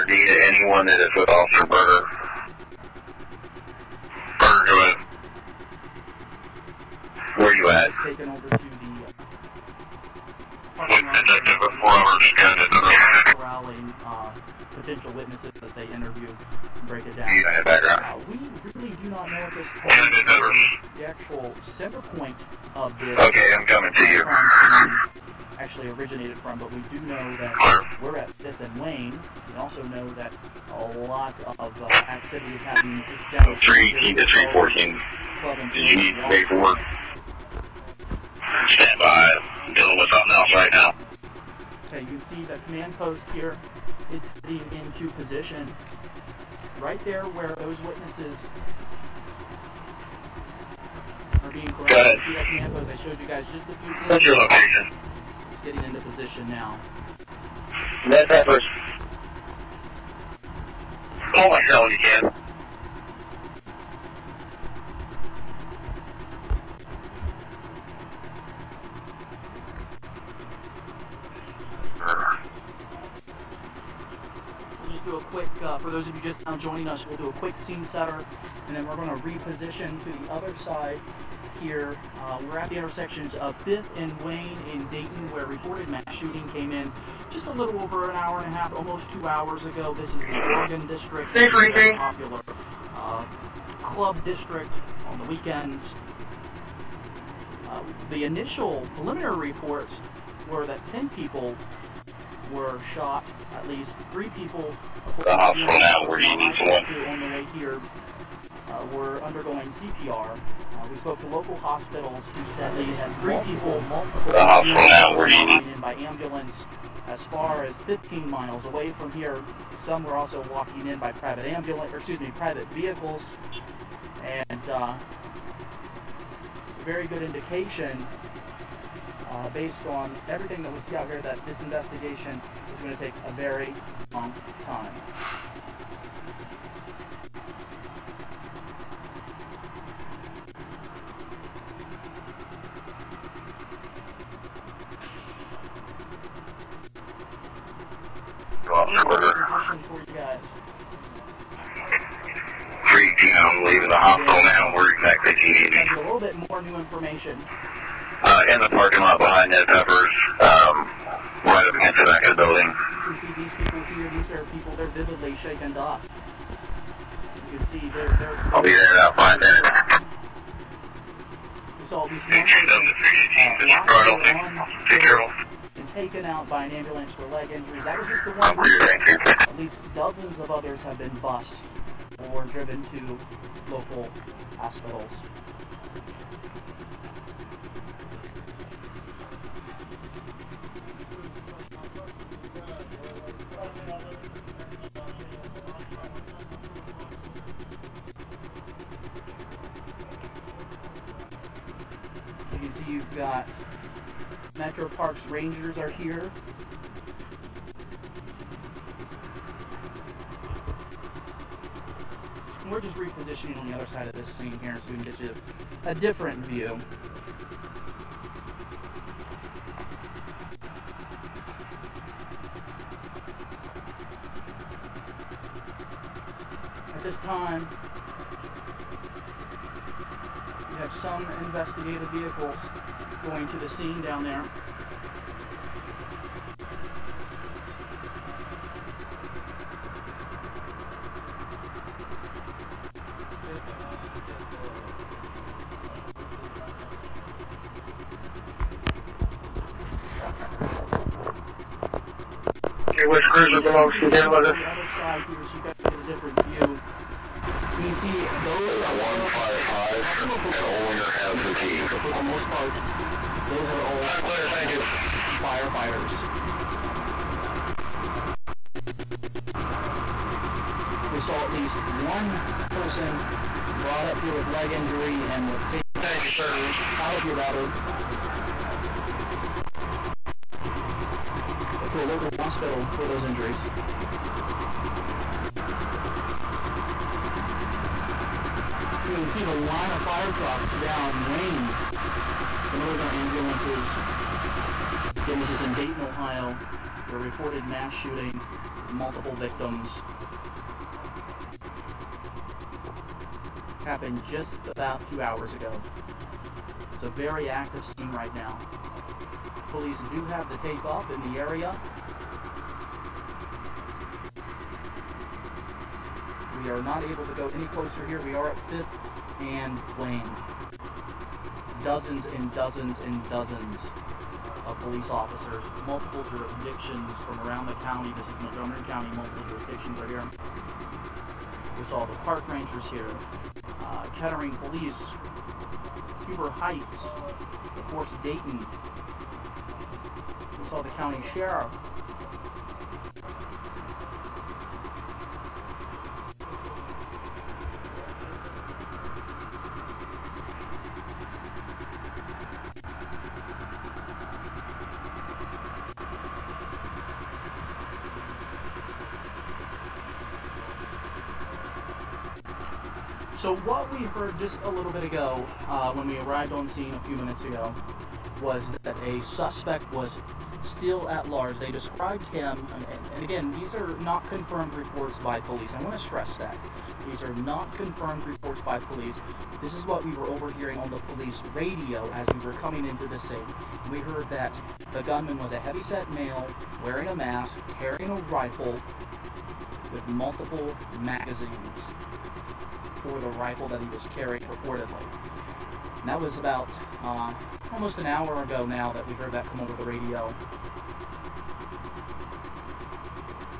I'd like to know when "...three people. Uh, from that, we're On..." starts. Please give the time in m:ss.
1:44.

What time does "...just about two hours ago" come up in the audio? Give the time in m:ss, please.
5:04.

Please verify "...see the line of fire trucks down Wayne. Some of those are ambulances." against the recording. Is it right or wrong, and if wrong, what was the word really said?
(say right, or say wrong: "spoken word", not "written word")
right.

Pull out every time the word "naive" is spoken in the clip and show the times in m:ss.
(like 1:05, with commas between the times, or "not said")
not said.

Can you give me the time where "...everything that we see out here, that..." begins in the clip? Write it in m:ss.
2:10.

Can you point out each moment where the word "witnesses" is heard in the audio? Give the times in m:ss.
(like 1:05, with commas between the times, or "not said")
0:15, 0:47.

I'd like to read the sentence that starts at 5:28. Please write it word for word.
This is Montgomery County, multiple jurisdictions are here.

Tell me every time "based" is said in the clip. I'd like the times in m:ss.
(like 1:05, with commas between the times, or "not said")
2:09.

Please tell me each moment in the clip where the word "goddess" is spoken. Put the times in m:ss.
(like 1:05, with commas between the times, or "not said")
not said.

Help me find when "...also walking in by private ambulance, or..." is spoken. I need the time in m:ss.
2:00.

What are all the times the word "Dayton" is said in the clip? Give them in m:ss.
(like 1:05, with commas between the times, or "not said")
1:24, 4:55, 5:38.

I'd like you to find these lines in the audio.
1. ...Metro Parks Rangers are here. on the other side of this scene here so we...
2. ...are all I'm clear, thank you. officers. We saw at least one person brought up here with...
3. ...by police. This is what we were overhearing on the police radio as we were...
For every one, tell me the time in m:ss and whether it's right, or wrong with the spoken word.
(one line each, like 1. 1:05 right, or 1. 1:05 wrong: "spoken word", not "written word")
1. 3:24 right
2. 4:23 wrong: "firefighters", not "officers"
3. 6:18 right.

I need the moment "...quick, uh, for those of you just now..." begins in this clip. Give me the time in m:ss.
1:15.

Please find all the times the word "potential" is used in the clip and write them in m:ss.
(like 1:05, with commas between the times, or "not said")
0:14.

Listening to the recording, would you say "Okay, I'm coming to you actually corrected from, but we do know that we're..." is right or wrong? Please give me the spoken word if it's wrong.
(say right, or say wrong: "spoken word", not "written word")
wrong: "originated", not "corrected".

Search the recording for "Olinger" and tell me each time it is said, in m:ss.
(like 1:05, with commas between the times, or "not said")
4:20.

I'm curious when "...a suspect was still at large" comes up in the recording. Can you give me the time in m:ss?
6:09.